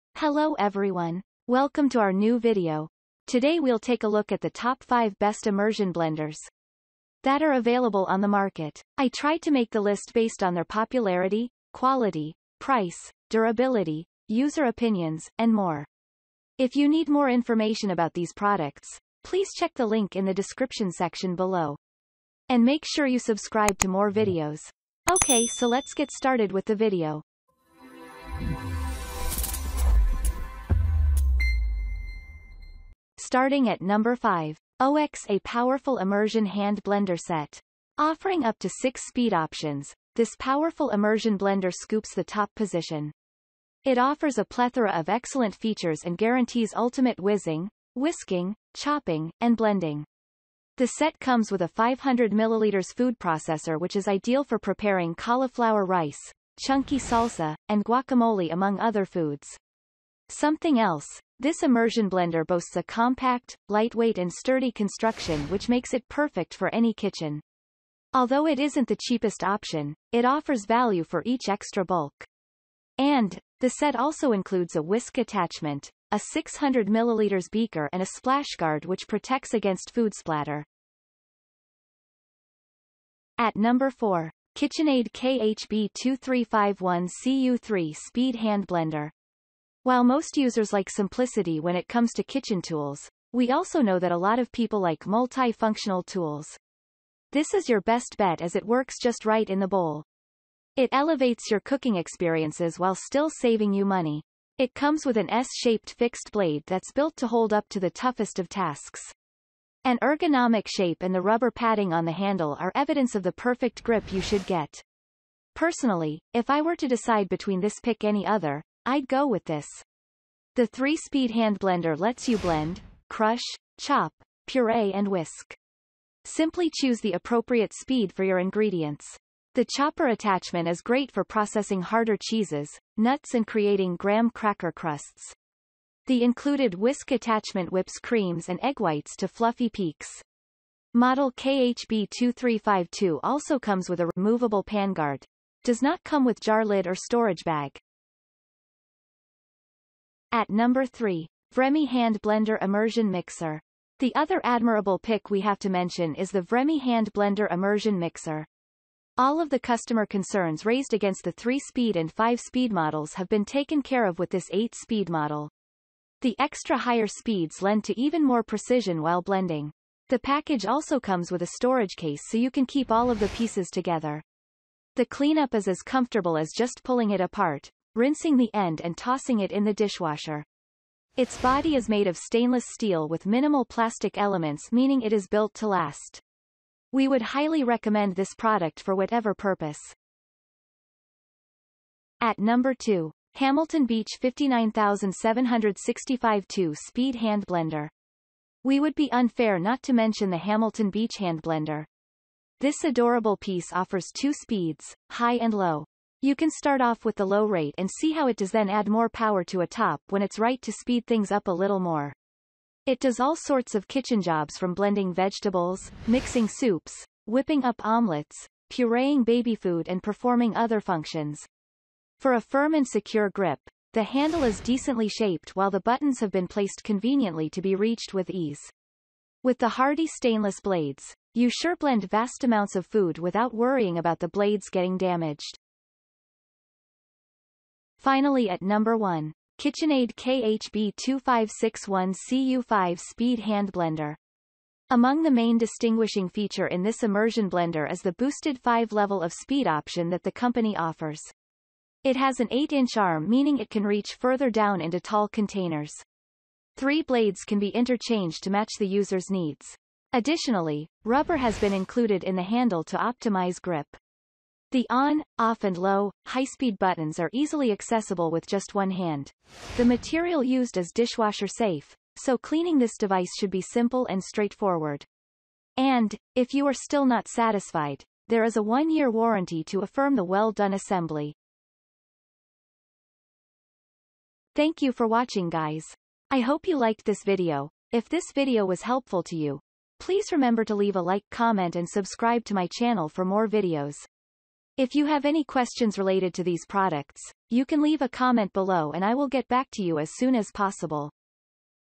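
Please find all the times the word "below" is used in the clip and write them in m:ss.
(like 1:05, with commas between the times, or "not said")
0:21, 4:58.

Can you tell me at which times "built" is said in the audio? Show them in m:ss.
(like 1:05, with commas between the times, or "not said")
1:46, 3:05.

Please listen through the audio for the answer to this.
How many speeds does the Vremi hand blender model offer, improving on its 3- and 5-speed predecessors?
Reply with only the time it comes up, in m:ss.
2:44.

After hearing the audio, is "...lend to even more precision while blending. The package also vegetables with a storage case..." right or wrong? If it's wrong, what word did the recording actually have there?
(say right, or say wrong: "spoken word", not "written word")
wrong: "comes", not "vegetables".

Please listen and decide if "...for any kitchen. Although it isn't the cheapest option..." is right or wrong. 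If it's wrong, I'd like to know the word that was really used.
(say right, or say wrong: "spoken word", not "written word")
right.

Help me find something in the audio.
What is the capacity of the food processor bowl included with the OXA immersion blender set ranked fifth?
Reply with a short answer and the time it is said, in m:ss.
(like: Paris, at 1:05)
500 milliliters, at 0:51.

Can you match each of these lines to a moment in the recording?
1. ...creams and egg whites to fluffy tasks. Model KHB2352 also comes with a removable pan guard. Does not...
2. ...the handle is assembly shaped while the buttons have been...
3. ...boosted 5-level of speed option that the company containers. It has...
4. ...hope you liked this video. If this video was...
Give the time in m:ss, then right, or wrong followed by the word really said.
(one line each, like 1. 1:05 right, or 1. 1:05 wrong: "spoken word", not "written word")
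1. 2:18 wrong: "peaks", not "tasks"
2. 3:43 wrong: "decently", not "assembly"
3. 4:08 wrong: "offers", not "containers"
4. 4:46 right.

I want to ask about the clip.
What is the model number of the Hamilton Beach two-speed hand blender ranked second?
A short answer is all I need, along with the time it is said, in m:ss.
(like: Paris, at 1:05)
59765, at 3:14.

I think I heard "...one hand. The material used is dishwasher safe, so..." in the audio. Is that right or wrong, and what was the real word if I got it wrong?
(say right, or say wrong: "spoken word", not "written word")
right.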